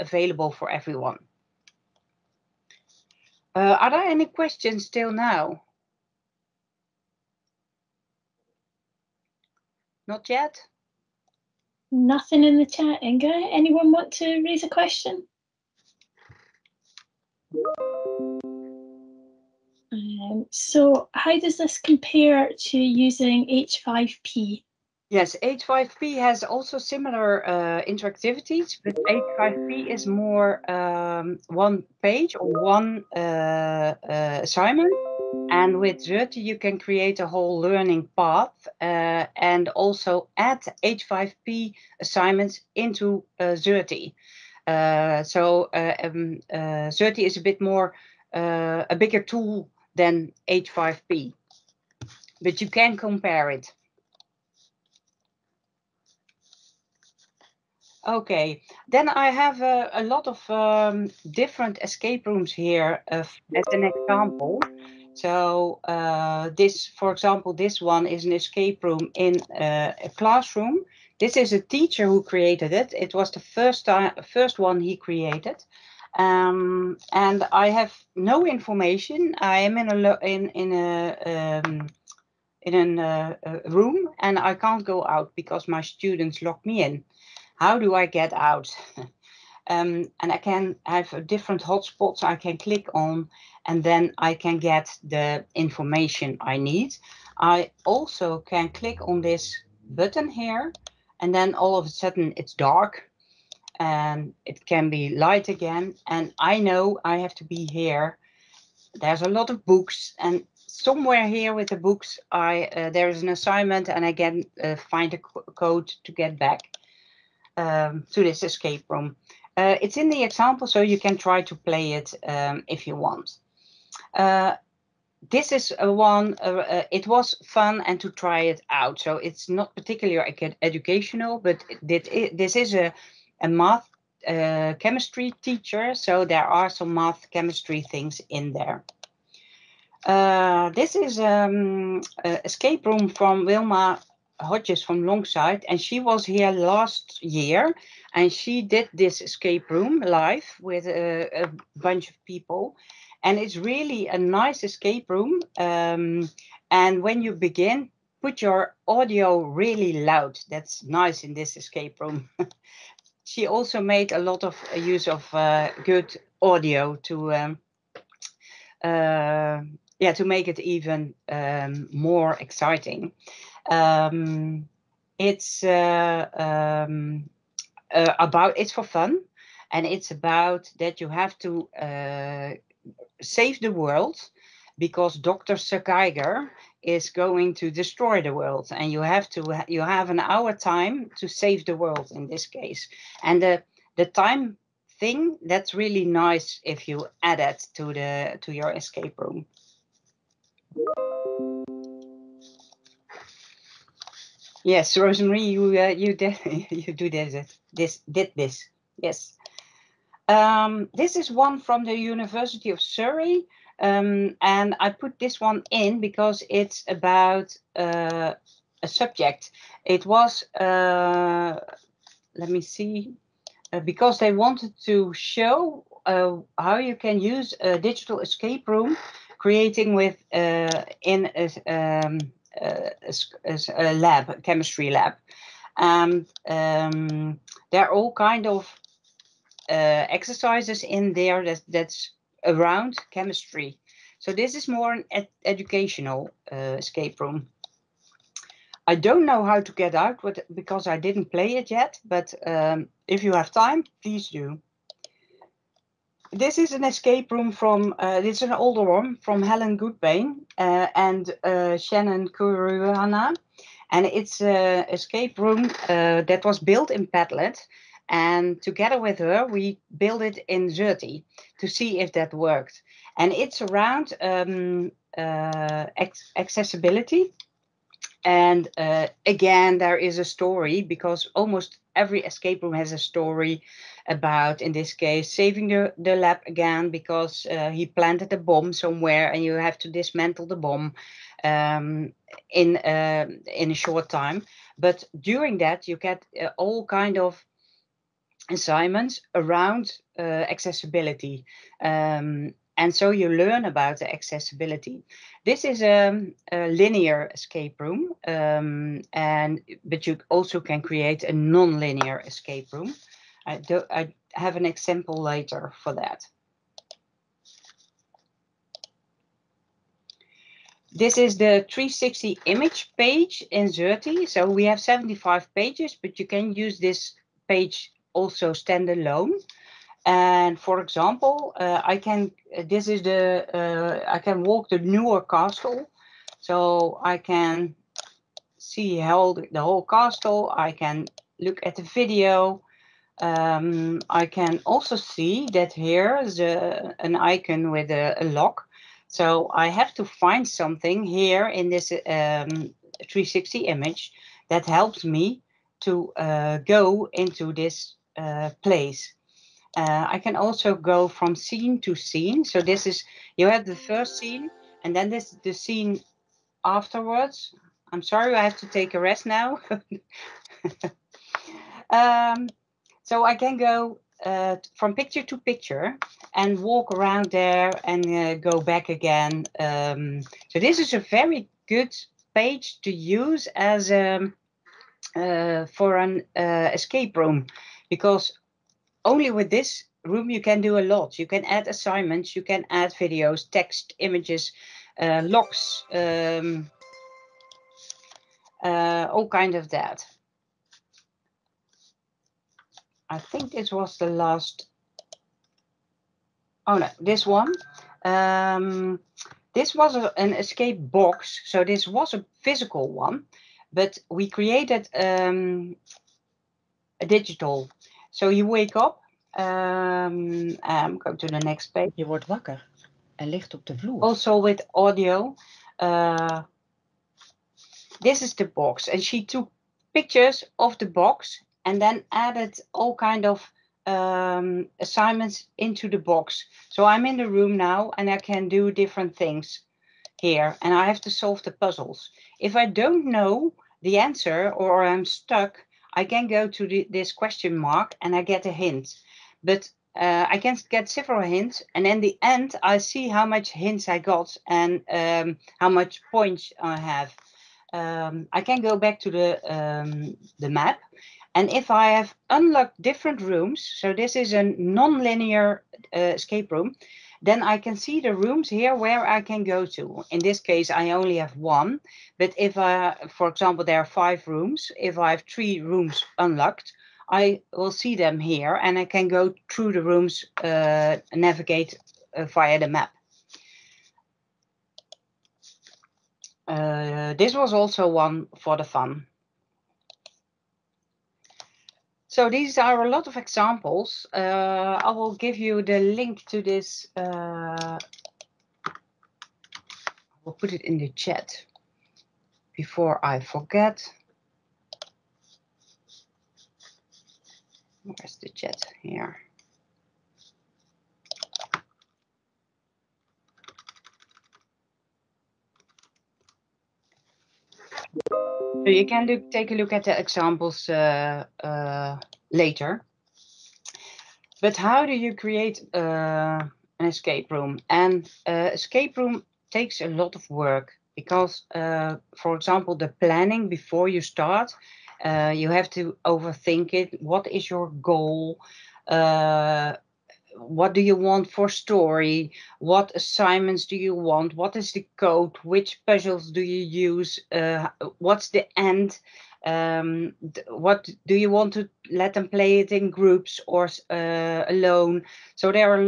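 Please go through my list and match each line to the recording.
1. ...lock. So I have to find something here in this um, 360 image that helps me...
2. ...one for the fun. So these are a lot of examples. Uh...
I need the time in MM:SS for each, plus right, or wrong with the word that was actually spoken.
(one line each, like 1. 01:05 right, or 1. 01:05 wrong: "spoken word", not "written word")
1. 05:48 right
2. 08:07 right.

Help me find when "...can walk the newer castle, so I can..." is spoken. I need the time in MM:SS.
05:34.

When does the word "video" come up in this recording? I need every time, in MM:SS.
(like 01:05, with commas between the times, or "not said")
05:41, 06:32.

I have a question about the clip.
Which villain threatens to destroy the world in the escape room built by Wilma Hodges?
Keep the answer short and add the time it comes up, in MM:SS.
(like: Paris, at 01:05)
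Dr. Sakaiger, at 03:05.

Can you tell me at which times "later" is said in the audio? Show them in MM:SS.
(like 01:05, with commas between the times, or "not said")
05:15, 08:42.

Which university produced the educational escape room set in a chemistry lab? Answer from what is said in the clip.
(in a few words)
University of Surrey.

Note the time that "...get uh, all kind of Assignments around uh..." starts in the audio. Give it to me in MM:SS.
04:55.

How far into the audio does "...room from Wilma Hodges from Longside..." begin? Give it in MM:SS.
02:22.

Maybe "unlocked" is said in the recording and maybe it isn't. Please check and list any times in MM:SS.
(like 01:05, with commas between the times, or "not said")
07:42, 07:56.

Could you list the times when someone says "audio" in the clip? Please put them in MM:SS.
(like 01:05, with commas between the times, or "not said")
02:38, 02:46, 07:04.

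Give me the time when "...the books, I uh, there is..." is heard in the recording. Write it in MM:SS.
01:51.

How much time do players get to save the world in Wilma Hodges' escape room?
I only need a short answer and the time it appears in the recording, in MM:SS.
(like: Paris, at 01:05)
An hour, at 03:10.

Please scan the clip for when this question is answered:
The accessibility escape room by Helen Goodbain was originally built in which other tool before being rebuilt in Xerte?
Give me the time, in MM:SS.
04:27.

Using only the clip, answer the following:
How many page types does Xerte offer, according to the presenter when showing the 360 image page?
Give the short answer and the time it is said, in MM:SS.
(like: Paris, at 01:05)
75, at 05:24.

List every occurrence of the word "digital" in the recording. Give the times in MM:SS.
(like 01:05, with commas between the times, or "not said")
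03:47, 06:57.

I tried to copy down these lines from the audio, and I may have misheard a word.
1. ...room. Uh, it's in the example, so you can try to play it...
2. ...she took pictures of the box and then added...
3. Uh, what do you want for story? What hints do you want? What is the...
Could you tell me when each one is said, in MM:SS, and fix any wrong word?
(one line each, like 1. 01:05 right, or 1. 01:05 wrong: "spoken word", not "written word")
1. 01:58 right
2. 07:09 right
3. 08:58 wrong: "assignments", not "hints".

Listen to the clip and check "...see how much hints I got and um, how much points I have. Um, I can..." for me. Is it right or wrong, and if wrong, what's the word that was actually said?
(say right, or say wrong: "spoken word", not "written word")
right.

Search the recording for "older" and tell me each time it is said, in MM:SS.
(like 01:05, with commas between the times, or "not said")
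04:18.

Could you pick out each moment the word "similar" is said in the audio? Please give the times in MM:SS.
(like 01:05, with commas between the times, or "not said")
00:26.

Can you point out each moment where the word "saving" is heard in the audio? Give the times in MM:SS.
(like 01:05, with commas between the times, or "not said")
04:45.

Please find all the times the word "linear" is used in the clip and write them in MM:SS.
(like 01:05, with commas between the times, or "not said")
05:06, 05:11, 07:44.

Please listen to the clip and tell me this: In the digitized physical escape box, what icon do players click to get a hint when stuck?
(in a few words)
Question mark.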